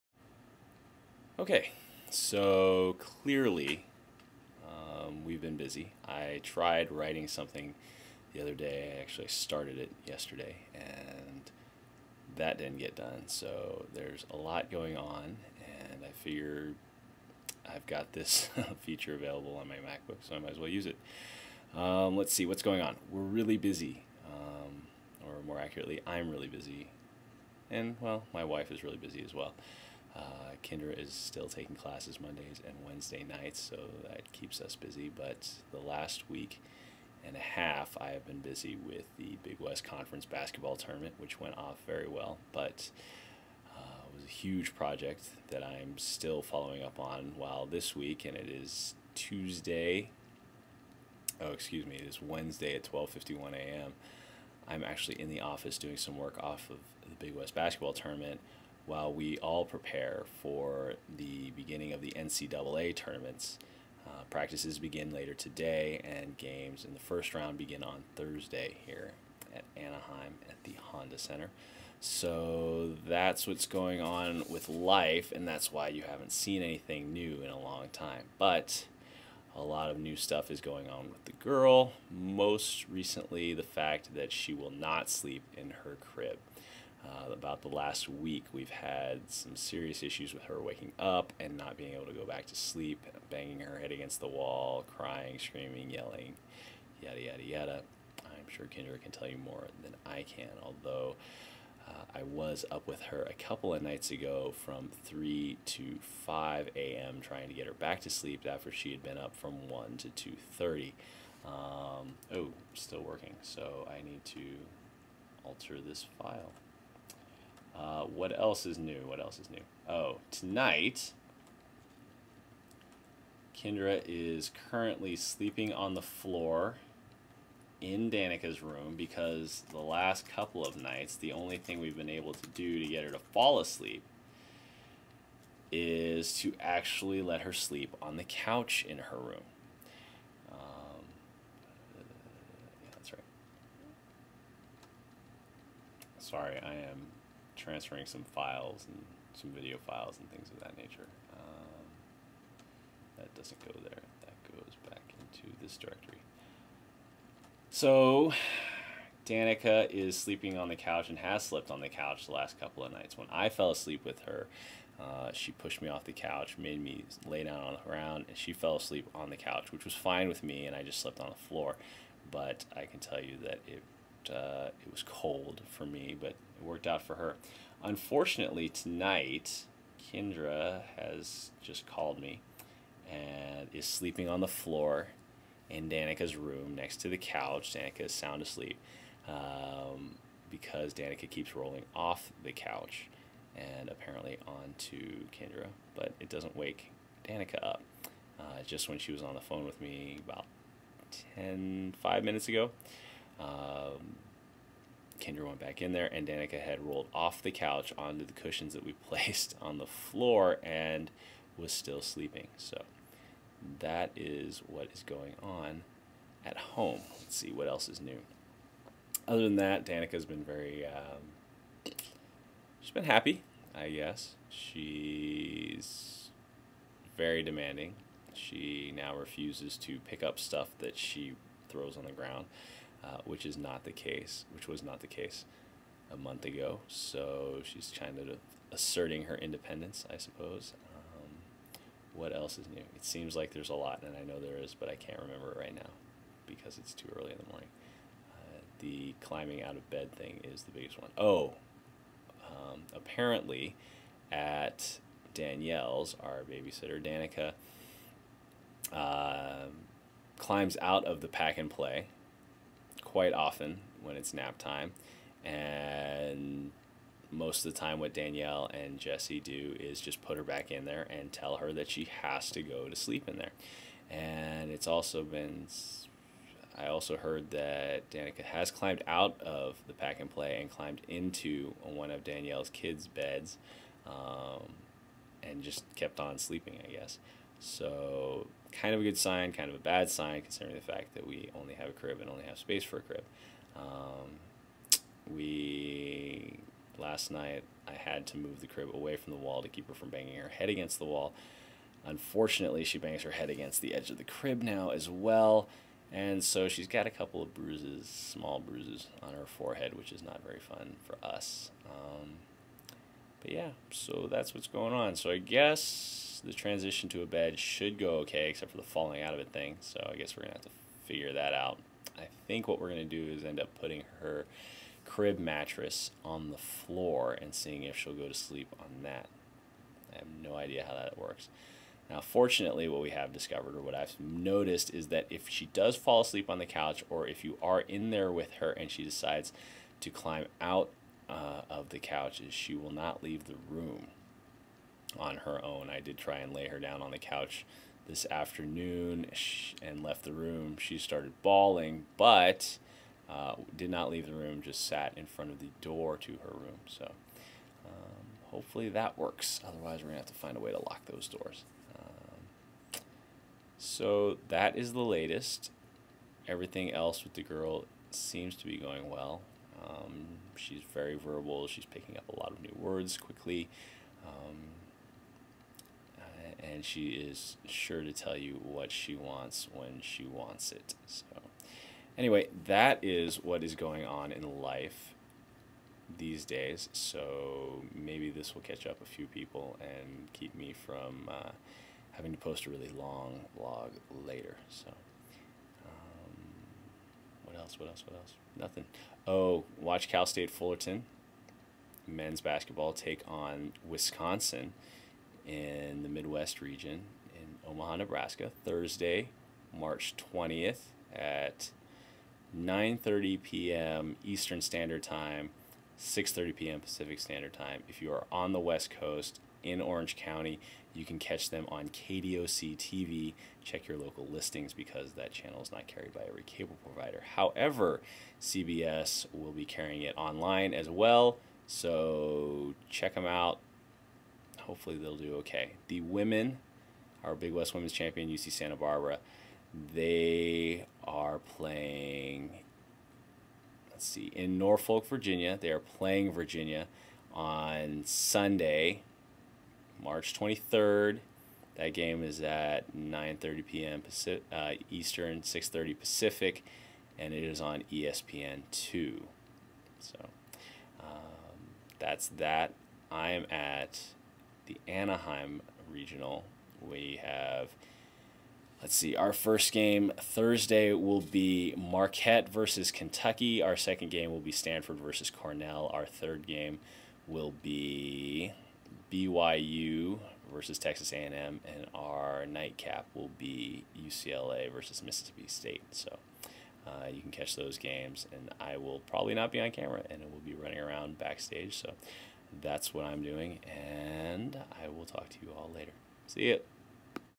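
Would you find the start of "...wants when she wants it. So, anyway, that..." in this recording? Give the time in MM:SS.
06:19.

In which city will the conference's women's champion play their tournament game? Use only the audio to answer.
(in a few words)
Norfolk, Virginia.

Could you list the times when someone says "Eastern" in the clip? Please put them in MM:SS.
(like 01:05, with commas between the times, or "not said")
06:54, 07:34.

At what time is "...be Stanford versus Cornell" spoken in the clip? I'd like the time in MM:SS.
07:54.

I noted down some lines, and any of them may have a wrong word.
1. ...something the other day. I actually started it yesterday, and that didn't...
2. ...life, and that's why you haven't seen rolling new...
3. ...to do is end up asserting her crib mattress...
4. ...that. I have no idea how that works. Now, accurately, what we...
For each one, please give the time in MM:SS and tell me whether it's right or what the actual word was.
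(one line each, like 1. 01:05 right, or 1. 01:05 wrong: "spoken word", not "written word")
1. 00:07 right
2. 01:14 wrong: "anything", not "rolling"
3. 05:23 wrong: "putting", not "asserting"
4. 05:29 wrong: "fortunately", not "accurately".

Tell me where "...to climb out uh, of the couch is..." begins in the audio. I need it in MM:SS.
05:40.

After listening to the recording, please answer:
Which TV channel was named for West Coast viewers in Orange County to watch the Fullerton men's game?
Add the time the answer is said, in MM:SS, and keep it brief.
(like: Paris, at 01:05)
KDOC TV, at 07:01.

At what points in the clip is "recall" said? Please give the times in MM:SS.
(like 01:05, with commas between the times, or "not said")
not said.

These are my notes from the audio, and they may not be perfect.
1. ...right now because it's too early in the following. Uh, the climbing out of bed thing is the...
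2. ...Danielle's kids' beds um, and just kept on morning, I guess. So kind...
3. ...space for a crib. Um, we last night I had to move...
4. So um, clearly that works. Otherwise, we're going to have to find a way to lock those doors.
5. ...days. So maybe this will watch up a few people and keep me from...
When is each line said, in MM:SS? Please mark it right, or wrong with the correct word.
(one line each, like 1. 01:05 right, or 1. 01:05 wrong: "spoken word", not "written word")
1. 04:05 wrong: "morning", not "following"
2. 04:42 wrong: "sleeping", not "morning"
3. 04:52 right
4. 05:56 wrong: "hopefully", not "clearly"
5. 06:26 wrong: "catch", not "watch".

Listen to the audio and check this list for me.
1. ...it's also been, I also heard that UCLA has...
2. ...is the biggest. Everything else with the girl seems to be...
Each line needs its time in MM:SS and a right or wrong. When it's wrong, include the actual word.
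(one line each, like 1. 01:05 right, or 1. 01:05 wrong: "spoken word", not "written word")
1. 04:34 wrong: "Danica", not "UCLA"
2. 06:04 wrong: "latest", not "biggest".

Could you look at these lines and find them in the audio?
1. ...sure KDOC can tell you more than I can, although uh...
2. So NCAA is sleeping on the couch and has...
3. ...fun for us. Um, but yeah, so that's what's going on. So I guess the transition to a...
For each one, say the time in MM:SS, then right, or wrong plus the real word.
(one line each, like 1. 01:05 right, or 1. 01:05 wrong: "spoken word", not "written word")
1. 01:38 wrong: "Kendra", not "KDOC"
2. 02:37 wrong: "Danica", not "NCAA"
3. 05:10 right.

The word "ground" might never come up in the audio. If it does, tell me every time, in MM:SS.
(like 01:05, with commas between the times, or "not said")
02:47, 03:52.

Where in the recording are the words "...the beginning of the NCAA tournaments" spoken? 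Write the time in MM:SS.
01:01.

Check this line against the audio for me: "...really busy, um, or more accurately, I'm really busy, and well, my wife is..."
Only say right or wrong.
right.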